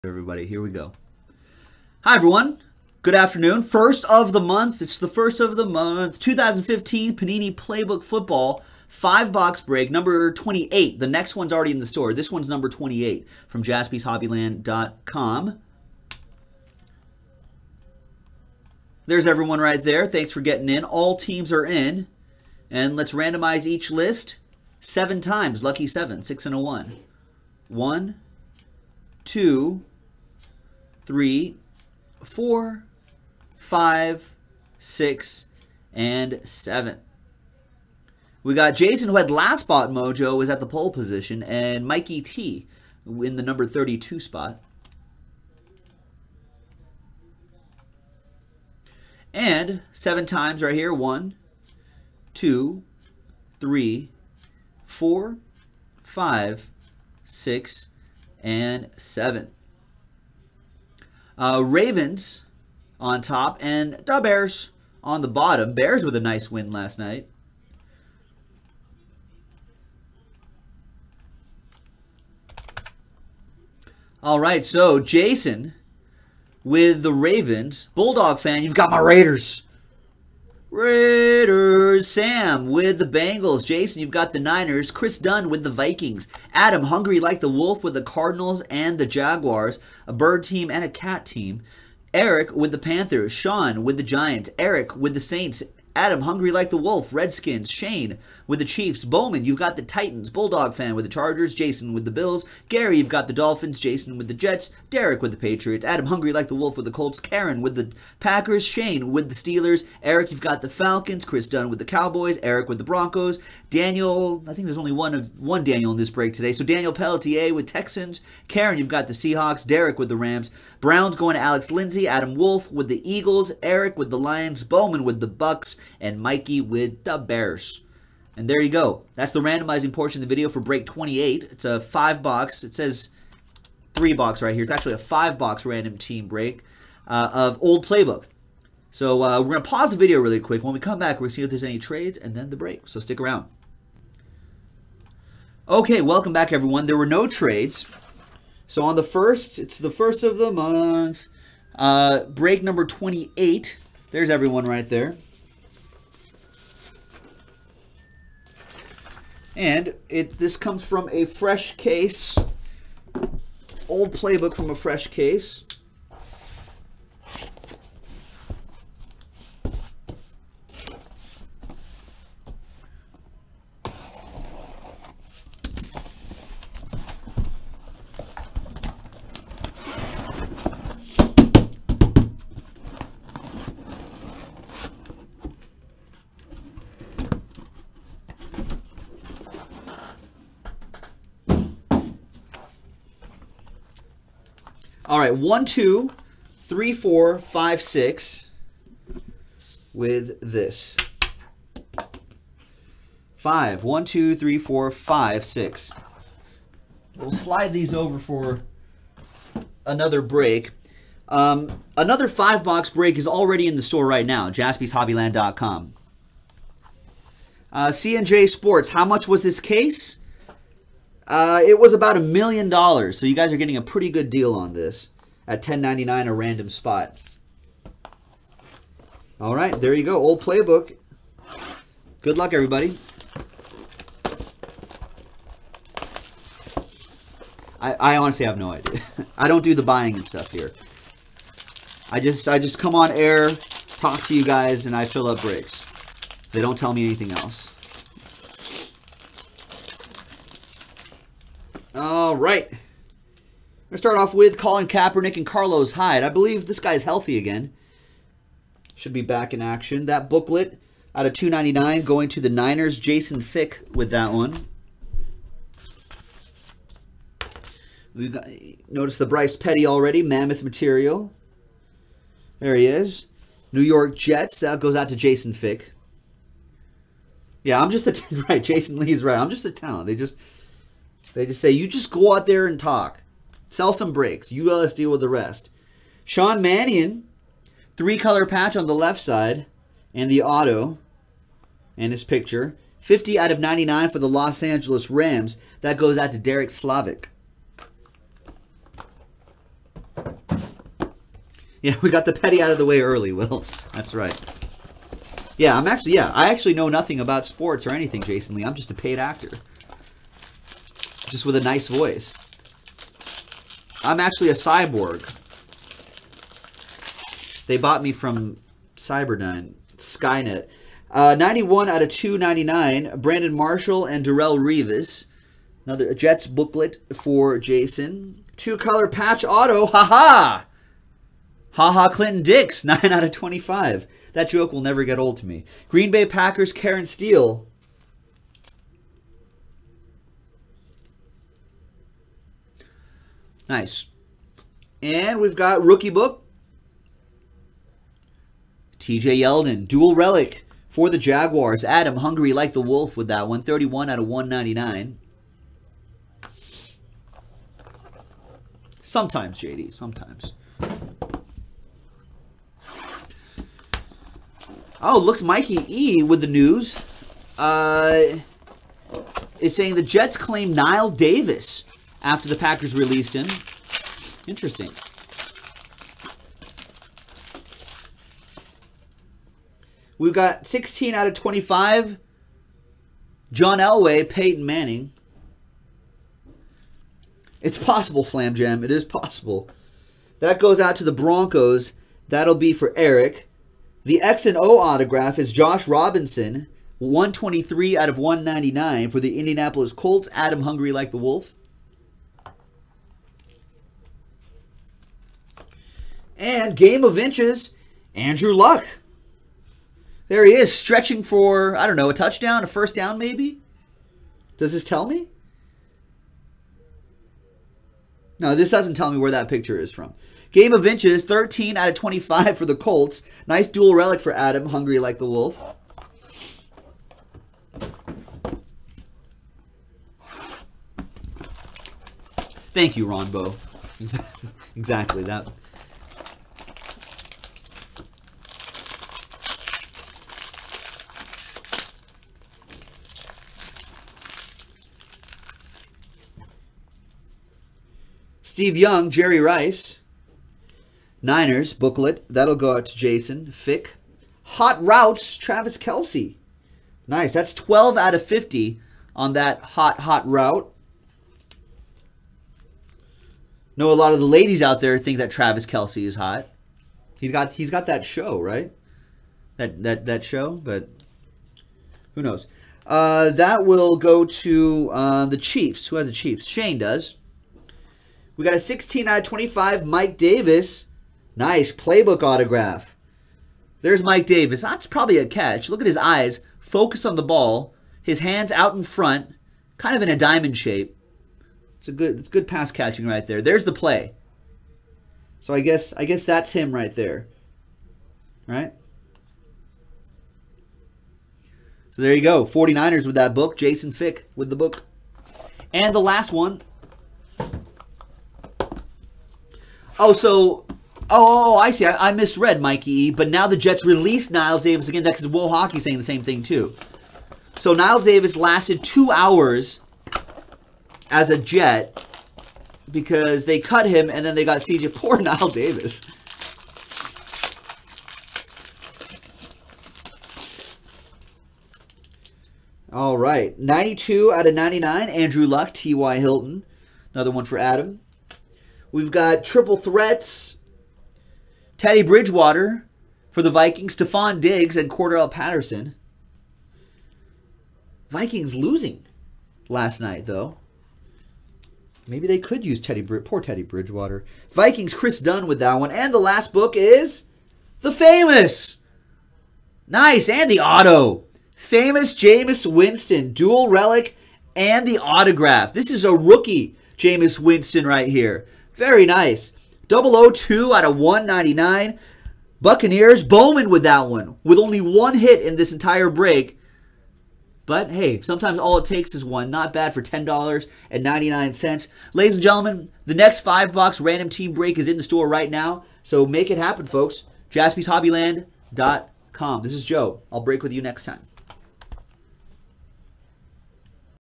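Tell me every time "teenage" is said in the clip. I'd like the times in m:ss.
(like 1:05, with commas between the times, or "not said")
not said.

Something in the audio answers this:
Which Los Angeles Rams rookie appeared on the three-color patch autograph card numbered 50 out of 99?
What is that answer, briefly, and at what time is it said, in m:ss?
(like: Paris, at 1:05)
Sean Mannion, at 4:46.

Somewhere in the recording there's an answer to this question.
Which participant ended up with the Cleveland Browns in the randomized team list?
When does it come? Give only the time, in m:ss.
2:01.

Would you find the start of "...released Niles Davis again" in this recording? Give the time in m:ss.
8:33.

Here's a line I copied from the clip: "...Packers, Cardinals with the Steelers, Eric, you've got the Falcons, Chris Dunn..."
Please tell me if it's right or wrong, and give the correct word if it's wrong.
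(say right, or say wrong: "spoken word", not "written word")
wrong: "Shane", not "Cardinals".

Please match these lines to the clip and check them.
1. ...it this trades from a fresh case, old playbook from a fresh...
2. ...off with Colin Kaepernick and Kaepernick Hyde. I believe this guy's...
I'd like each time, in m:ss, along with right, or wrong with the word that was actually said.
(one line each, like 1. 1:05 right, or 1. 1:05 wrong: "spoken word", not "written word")
1. 2:40 wrong: "comes", not "trades"
2. 4:14 wrong: "Carlos", not "Kaepernick".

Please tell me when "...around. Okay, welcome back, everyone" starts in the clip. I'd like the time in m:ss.
2:23.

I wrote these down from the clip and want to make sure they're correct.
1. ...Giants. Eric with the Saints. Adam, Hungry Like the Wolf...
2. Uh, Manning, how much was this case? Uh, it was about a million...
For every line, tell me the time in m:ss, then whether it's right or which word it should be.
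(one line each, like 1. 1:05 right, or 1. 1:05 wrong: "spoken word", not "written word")
1. 1:34 right
2. 3:37 wrong: "Sports", not "Manning".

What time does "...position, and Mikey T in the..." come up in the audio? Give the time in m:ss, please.
0:40.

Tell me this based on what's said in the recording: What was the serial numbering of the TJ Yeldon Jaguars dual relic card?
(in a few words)
31 out of 199.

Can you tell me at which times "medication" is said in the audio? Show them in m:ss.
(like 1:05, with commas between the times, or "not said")
not said.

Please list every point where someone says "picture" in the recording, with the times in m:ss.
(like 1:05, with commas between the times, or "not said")
4:52, 6:59.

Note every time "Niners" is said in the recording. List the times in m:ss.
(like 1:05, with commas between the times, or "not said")
1:24, 4:22, 7:31.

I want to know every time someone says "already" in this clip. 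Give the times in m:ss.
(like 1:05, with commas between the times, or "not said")
0:11, 3:33, 4:29.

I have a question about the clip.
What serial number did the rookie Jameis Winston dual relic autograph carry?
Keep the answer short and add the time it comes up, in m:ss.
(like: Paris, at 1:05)
002 out of 199, at 9:29.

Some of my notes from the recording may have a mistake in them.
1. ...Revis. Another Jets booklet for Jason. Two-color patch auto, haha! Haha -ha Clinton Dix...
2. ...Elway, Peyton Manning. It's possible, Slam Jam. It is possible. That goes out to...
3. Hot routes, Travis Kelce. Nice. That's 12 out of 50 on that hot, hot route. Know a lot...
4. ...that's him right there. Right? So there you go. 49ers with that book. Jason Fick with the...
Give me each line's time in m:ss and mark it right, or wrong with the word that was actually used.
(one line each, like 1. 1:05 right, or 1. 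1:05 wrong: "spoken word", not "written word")
1. 5:24 right
2. 6:23 right
3. 7:34 right
4. 8:16 right.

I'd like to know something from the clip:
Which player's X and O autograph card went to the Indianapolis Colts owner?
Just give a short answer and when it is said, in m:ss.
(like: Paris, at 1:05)
Josh Robinson, at 6:35.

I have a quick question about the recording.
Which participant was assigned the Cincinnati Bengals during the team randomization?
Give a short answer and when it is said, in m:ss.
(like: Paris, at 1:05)
Sam, at 1:22.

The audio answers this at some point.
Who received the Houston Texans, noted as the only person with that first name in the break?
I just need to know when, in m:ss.
1:56.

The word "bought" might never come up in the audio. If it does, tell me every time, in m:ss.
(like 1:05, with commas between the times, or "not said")
5:17.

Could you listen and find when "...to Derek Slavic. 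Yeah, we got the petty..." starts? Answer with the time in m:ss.
4:56.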